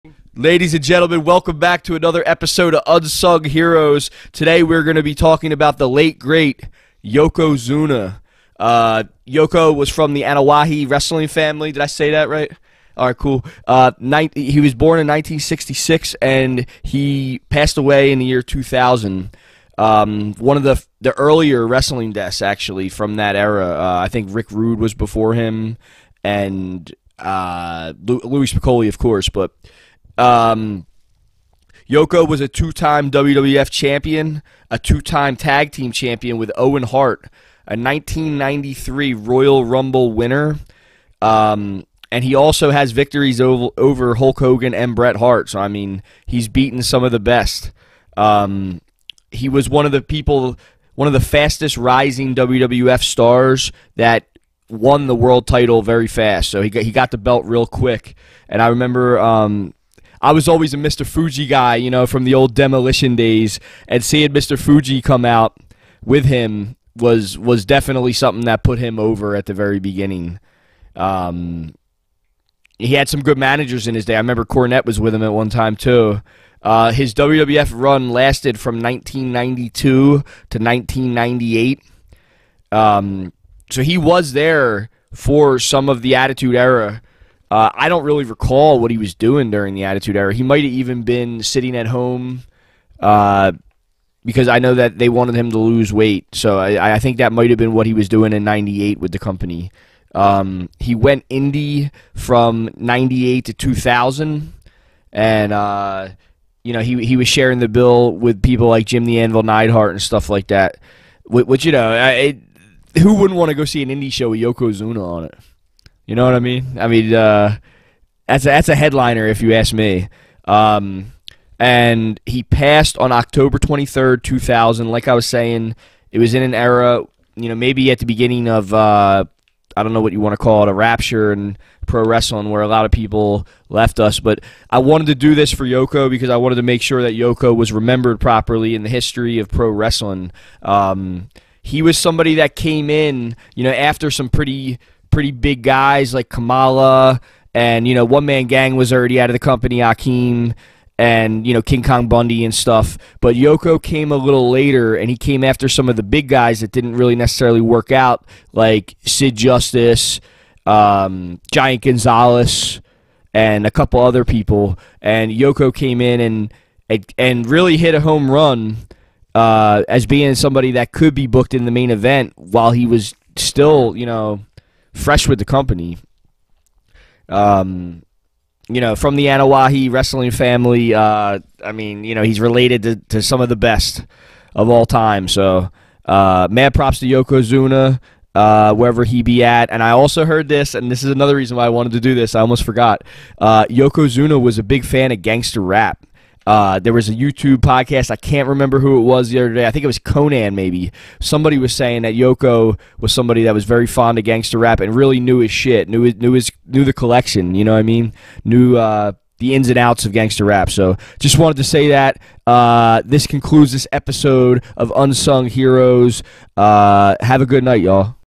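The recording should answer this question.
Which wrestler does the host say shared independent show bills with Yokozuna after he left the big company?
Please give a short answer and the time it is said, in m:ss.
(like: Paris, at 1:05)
Jim the Anvil Neidhart, at 1:48.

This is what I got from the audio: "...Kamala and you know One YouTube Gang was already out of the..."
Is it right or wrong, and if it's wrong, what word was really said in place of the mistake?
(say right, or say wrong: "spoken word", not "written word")
wrong: "Man", not "YouTube".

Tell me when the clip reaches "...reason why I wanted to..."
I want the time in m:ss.
3:11.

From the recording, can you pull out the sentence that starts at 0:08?
Uh, Yoko was from the Anoa'i wrestling family.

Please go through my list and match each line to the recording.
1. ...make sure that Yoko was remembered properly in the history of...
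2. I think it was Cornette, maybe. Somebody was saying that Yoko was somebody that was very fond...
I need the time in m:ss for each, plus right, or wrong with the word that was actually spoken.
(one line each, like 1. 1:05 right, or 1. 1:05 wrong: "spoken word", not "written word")
1. 2:16 right
2. 3:19 wrong: "Konnan", not "Cornette".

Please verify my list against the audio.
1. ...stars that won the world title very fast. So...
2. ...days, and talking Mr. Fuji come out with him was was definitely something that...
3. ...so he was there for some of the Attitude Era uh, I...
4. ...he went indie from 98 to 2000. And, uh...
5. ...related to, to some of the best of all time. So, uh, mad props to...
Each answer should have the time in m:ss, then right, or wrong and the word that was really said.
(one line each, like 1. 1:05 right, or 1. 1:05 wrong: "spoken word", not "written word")
1. 0:53 right
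2. 1:03 wrong: "seeing", not "talking"
3. 1:23 right
4. 1:40 right
5. 3:02 right.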